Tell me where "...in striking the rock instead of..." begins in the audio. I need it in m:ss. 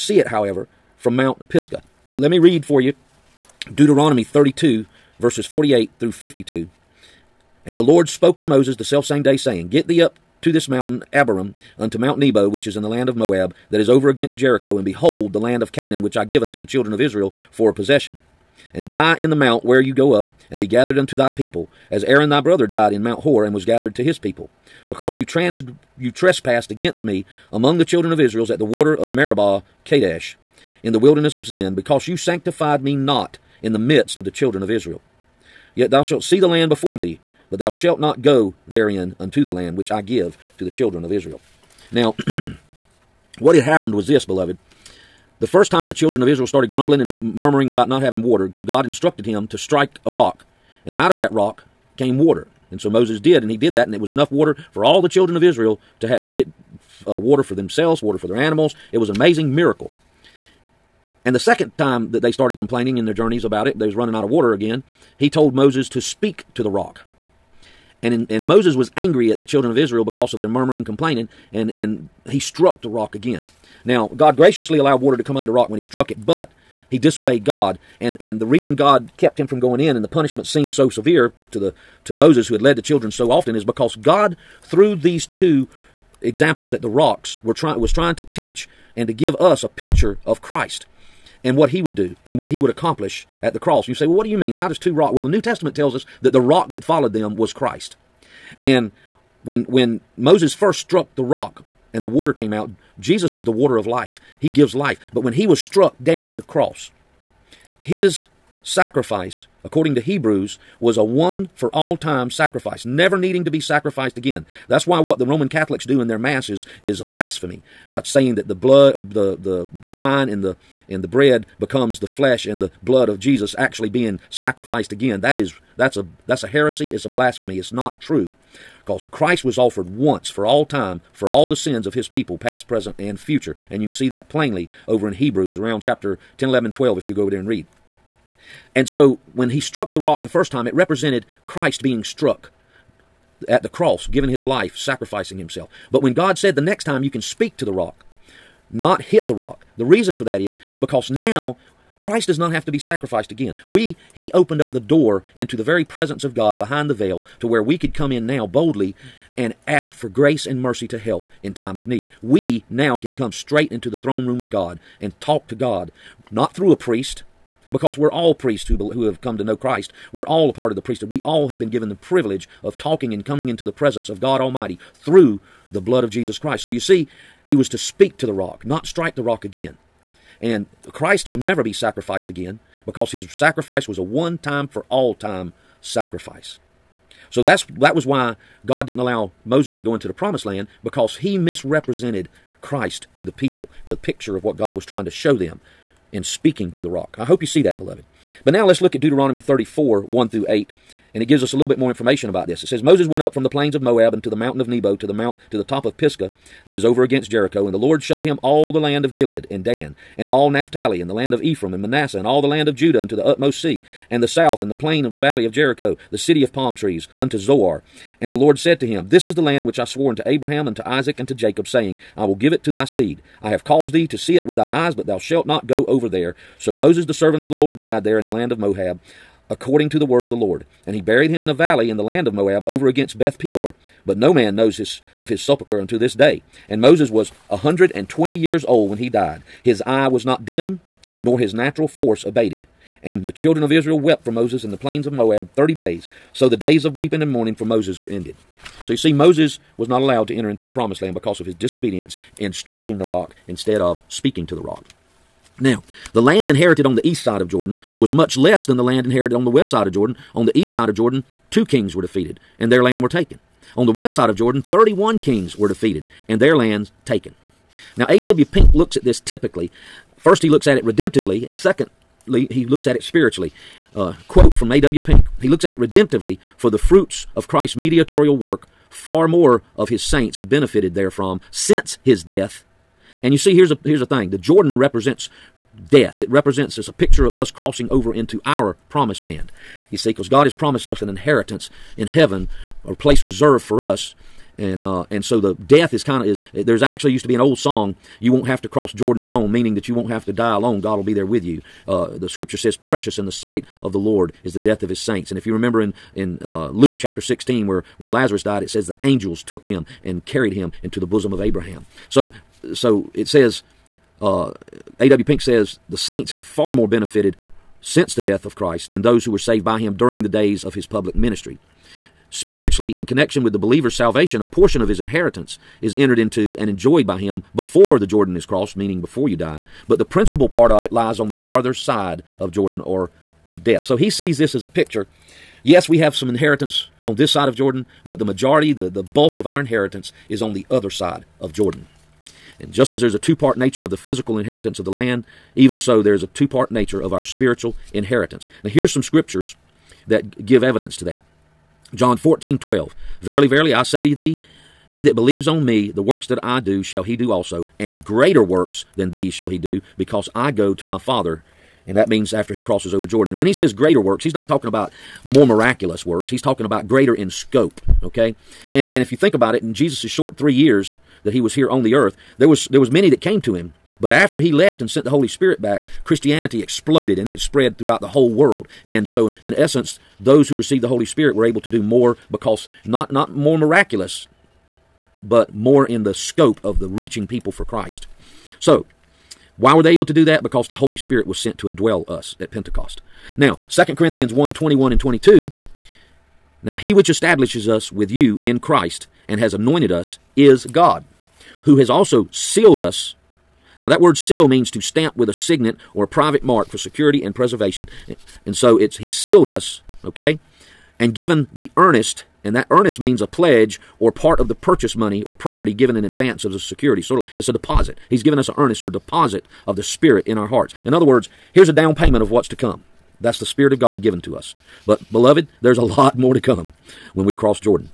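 4:12.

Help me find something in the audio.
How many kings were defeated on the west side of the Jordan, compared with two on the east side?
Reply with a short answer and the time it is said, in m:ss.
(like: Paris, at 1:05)
31, at 4:24.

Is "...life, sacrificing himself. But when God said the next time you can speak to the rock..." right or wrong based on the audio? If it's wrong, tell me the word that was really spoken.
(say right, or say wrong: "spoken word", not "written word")
right.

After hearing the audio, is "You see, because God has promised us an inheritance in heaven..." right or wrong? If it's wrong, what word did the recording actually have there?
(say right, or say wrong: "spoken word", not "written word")
right.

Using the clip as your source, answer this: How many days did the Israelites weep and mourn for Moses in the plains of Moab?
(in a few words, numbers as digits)
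30.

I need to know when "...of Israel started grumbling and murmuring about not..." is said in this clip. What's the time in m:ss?
0:46.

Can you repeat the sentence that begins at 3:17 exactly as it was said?
I hope you see that, beloved.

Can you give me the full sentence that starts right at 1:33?
and You say, well, what do you mean?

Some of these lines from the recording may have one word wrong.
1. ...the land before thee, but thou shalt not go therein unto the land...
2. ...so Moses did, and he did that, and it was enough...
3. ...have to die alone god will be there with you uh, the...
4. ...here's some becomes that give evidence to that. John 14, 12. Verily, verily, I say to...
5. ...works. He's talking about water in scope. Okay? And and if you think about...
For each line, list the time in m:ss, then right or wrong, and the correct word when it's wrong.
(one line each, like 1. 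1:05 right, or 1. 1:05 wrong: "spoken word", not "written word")
1. 0:36 right
2. 0:52 right
3. 5:00 right
4. 5:48 wrong: "scriptures", not "becomes"
5. 6:06 wrong: "greater", not "water".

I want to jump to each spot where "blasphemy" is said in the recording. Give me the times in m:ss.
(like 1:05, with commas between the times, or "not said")
1:57, 2:07.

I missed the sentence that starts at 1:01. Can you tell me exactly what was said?
And the second time that they started complaining in their journeys about it, they was running out of water again.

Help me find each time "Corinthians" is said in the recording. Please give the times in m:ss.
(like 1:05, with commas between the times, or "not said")
6:33.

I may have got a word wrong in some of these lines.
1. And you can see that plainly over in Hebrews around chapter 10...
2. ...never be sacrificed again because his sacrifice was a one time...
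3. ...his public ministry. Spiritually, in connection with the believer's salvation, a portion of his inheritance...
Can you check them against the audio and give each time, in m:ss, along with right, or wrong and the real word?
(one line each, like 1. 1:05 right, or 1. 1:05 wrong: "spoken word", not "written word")
1. 2:13 right
2. 3:01 right
3. 5:20 right.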